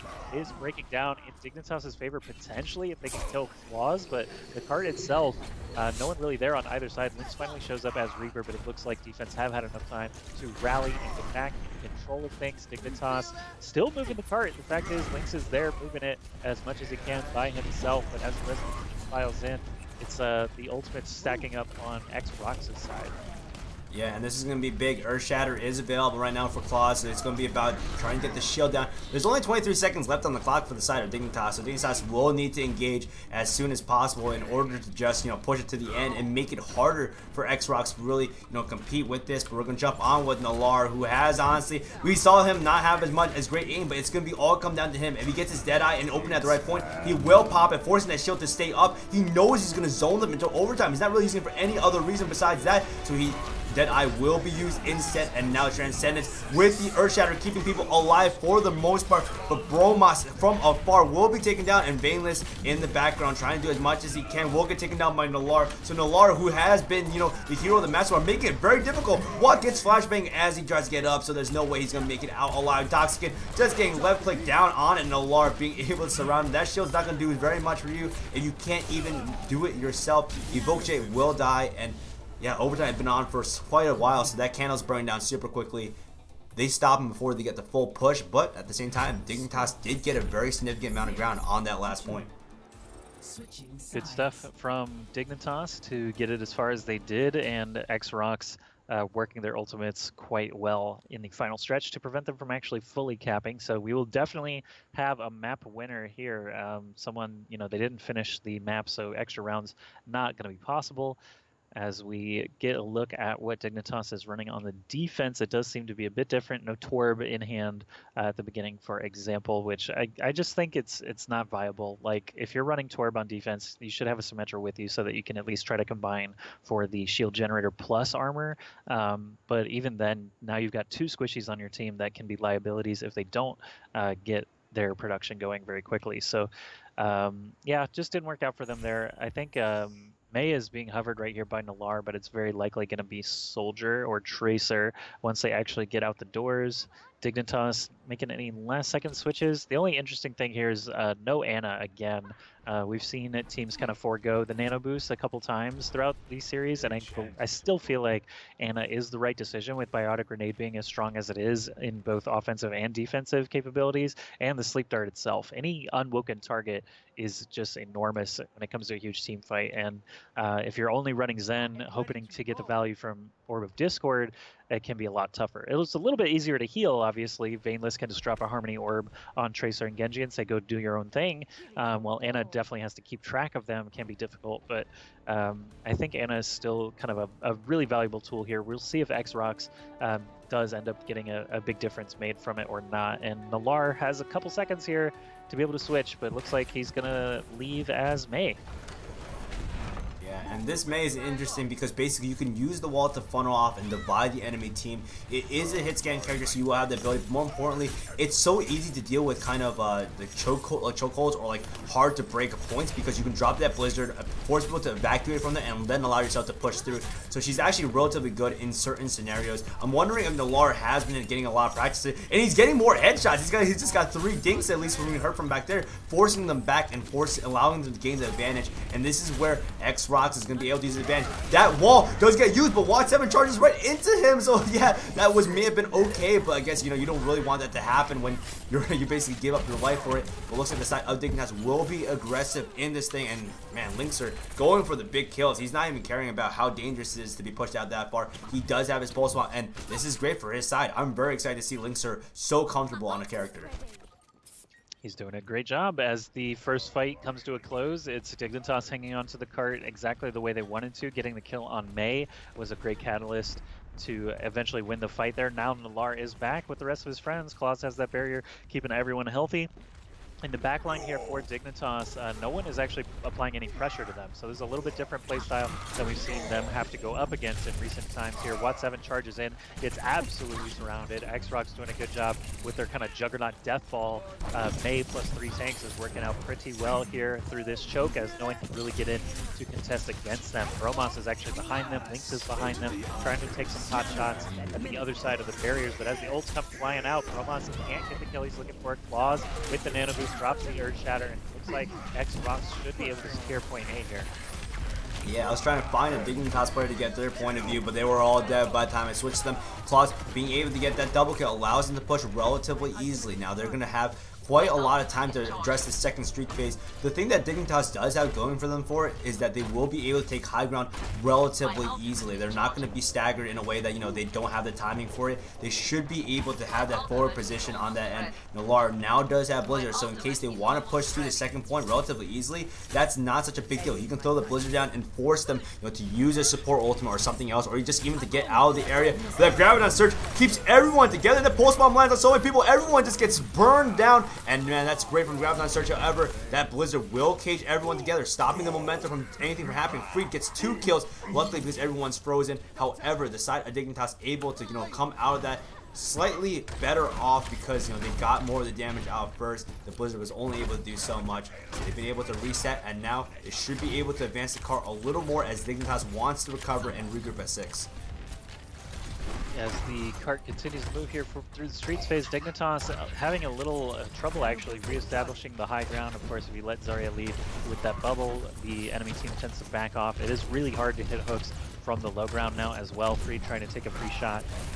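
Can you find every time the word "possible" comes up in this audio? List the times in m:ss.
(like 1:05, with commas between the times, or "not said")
0:33, 1:50.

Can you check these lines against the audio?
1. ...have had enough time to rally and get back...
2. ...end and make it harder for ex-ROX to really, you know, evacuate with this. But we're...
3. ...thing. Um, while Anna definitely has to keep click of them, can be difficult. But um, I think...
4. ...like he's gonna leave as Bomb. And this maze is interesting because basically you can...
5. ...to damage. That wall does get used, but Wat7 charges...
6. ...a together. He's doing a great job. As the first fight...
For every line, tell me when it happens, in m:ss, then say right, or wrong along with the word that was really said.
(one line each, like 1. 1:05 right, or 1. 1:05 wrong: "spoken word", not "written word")
1. 0:09 right
2. 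0:35 wrong: "compete", not "evacuate"
3. 3:01 wrong: "track", not "click"
4. 3:16 wrong: "Mei", not "Bomb"
5. 3:50 wrong: "advantage", not "damage"
6. 4:13 wrong: "character", not "together".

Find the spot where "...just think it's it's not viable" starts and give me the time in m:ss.
2:00.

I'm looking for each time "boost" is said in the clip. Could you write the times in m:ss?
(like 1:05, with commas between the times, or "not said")
2:34, 5:00.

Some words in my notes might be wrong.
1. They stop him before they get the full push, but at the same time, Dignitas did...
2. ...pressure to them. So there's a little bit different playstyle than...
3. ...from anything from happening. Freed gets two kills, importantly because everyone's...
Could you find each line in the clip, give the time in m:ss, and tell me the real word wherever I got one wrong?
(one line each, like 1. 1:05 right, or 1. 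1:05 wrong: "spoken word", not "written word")
1. 1:26 right
2. 4:33 right
3. 5:49 wrong: "luckily", not "importantly".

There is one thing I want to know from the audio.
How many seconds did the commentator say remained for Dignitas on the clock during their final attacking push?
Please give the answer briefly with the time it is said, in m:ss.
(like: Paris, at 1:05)
23, at 0:29.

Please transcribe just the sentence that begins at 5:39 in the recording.
But that Graviton Surge keeps everyone together.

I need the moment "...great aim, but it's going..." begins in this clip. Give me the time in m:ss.
0:43.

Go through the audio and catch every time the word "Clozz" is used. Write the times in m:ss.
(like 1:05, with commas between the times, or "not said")
0:03, 0:26, 4:27, 4:59, 5:09.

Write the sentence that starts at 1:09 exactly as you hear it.
What gets flashbang as he tries to get up so there's no way he's going to make it out alive.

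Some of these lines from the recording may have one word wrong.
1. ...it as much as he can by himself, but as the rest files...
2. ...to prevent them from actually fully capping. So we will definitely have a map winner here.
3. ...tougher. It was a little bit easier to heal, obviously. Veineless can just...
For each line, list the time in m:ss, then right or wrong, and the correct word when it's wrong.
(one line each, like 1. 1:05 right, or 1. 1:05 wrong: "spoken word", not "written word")
1. 0:16 right
2. 1:41 right
3. 2:55 right.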